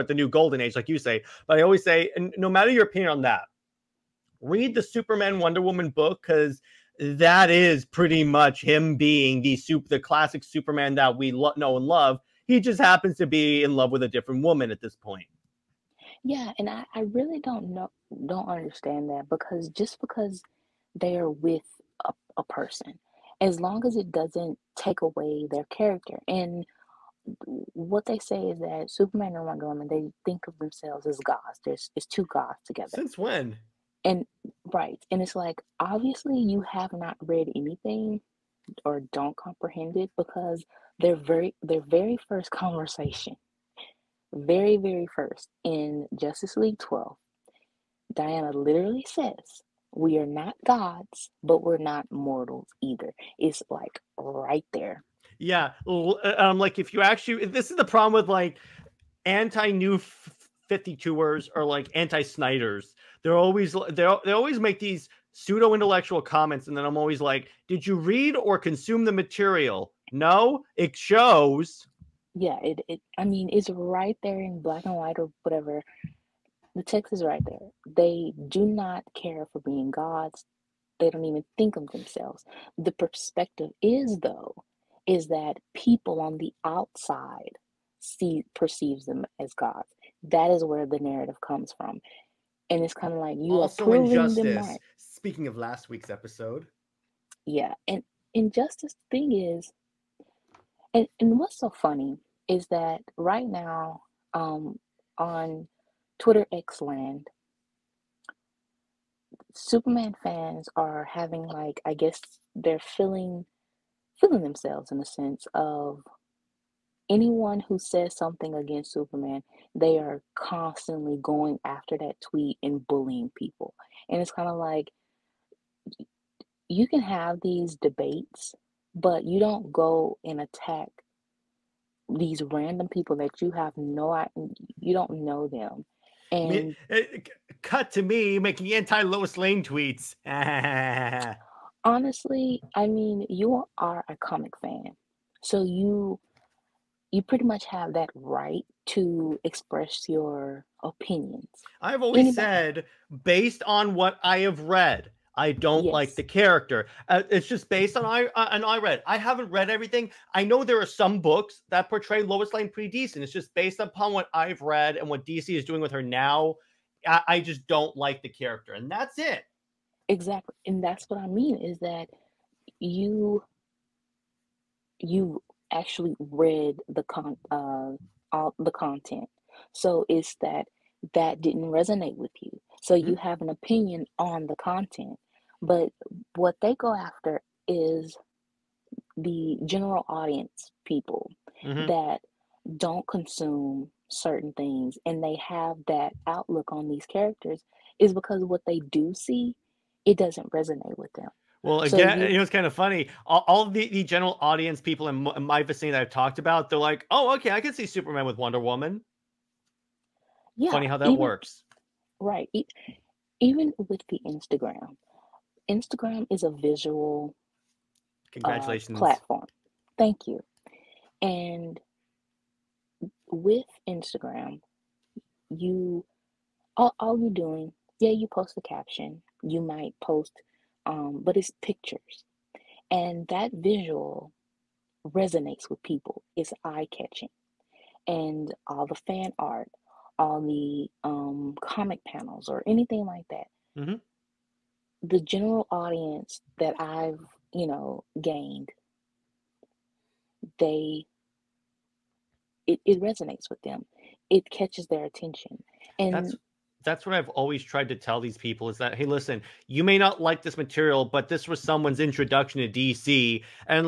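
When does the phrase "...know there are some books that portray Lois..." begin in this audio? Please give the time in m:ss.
2:40.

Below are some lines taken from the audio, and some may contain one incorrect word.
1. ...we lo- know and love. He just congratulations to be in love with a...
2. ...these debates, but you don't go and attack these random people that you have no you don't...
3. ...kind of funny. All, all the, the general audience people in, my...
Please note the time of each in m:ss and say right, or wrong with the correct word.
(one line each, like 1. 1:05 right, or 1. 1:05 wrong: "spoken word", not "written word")
1. 0:11 wrong: "happens", not "congratulations"
2. 2:07 right
3. 3:22 right.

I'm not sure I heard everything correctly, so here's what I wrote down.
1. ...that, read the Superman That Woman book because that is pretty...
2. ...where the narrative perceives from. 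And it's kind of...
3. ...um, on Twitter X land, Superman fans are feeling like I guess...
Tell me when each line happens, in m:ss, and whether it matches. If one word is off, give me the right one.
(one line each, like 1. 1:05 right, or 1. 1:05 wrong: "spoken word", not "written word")
1. 0:03 wrong: "Wonder", not "That"
2. 1:30 wrong: "comes", not "perceives"
3. 1:44 wrong: "having", not "feeling".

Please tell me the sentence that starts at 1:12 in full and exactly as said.
Yeah, it, it I mean, it's right there in black and white or whatever.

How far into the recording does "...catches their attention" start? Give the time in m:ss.
4:14.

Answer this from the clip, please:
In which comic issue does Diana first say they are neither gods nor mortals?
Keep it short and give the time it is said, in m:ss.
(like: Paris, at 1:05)
Justice League 12, at 0:46.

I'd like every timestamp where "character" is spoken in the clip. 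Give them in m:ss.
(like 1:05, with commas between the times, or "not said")
0:25, 2:36, 2:48, 3:17.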